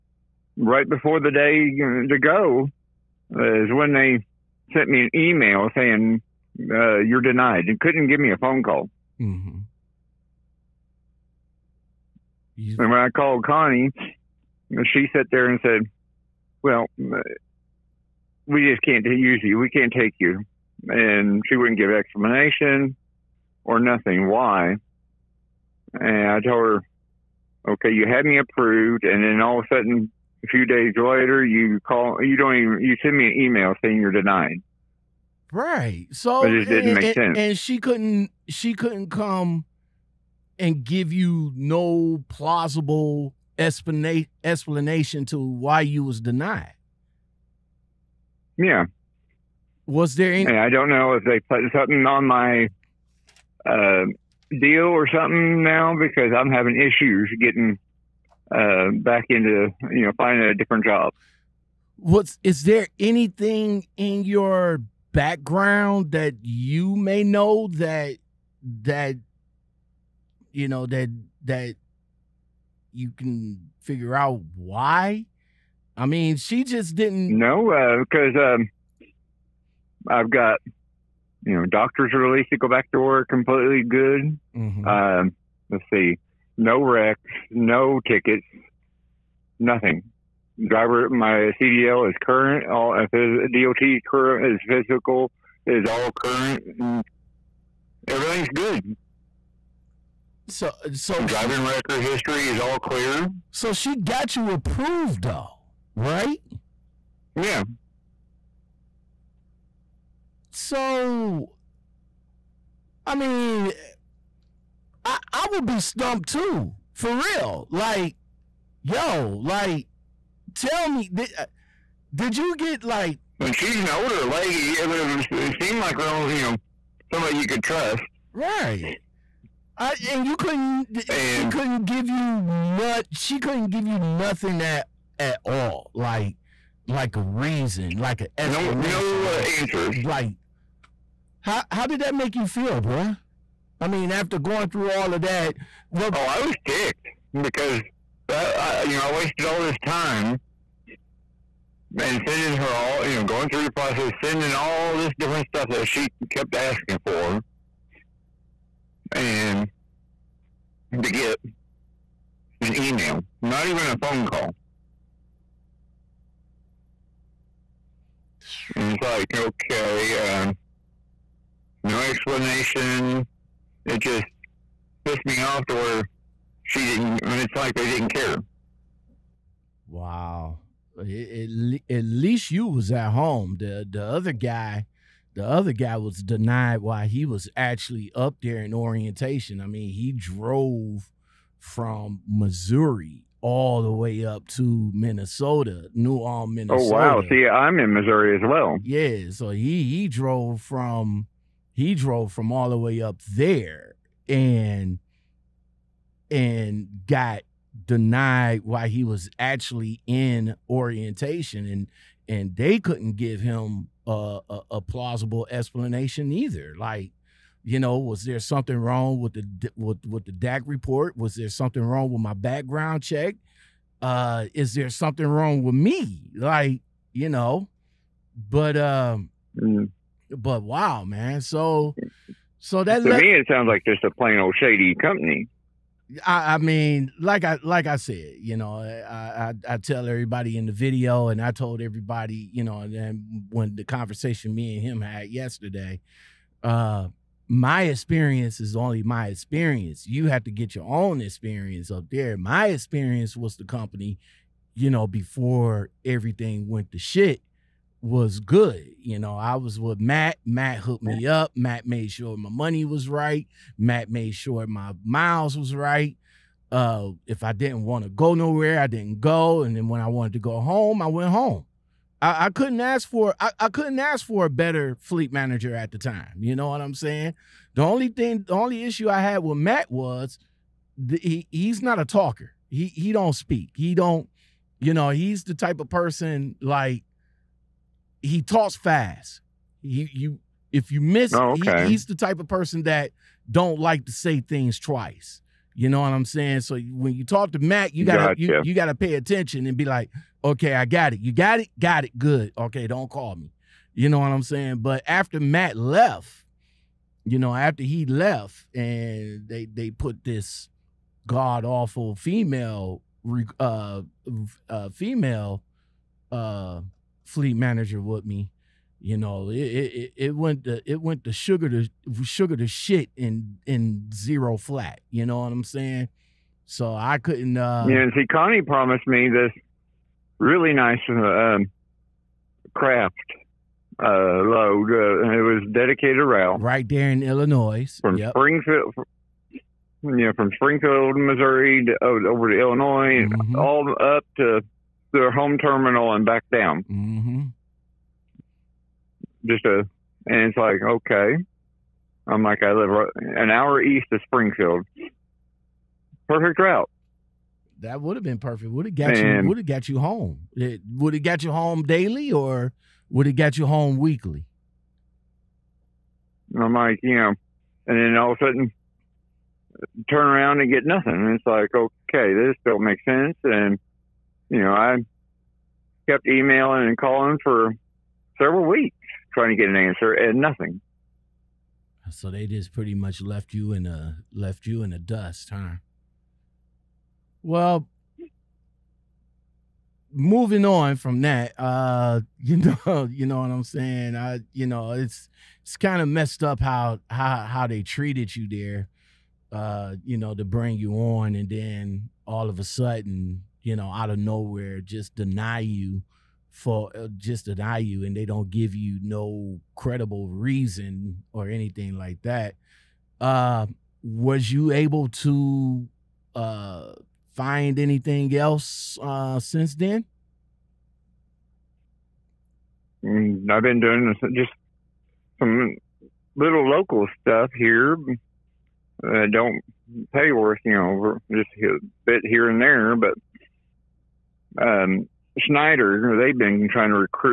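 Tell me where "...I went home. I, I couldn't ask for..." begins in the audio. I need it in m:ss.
4:31.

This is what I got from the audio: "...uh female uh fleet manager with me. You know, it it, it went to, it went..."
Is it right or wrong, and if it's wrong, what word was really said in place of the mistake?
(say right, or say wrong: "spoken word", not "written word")
right.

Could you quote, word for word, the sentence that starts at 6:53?
Uh, was you able to uh, find anything else uh, since then?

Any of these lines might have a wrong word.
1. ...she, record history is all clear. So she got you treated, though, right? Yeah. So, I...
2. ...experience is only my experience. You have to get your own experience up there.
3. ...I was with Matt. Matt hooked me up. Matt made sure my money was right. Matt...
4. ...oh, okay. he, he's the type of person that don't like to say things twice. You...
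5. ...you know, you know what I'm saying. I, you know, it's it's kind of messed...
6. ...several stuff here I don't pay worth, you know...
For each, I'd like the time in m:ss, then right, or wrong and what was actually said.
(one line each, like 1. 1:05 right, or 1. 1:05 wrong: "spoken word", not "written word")
1. 1:41 wrong: "approved", not "treated"
2. 4:07 right
3. 4:19 right
4. 4:51 right
5. 6:32 right
6. 7:06 wrong: "local", not "several".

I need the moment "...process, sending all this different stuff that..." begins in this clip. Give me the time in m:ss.
2:33.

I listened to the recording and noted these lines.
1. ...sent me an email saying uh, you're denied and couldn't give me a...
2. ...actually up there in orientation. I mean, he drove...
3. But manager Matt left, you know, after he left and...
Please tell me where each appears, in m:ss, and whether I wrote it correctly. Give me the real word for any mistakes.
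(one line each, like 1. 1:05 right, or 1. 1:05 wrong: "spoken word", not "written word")
1. 0:04 right
2. 3:07 right
3. 5:04 wrong: "after", not "manager".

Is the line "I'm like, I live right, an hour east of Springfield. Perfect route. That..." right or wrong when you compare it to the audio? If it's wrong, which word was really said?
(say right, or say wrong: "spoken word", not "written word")
right.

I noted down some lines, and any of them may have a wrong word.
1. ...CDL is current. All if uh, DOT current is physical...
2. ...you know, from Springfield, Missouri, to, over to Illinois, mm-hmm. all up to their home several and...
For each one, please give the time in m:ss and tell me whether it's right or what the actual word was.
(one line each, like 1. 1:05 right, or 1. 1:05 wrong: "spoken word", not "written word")
1. 1:31 right
2. 5:40 wrong: "terminal", not "several".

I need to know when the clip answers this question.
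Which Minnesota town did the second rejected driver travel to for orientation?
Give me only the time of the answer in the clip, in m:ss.
3:15.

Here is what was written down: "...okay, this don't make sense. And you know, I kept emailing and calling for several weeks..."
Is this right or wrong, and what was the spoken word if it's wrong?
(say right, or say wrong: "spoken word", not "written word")
right.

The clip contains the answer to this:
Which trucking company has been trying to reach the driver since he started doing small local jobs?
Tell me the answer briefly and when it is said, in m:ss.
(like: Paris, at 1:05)
Schneider, at 7:15.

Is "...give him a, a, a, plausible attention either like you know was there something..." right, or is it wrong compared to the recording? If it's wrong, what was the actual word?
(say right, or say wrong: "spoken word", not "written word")
wrong: "explanation", not "attention".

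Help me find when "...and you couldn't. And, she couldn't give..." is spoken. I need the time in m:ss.
2:10.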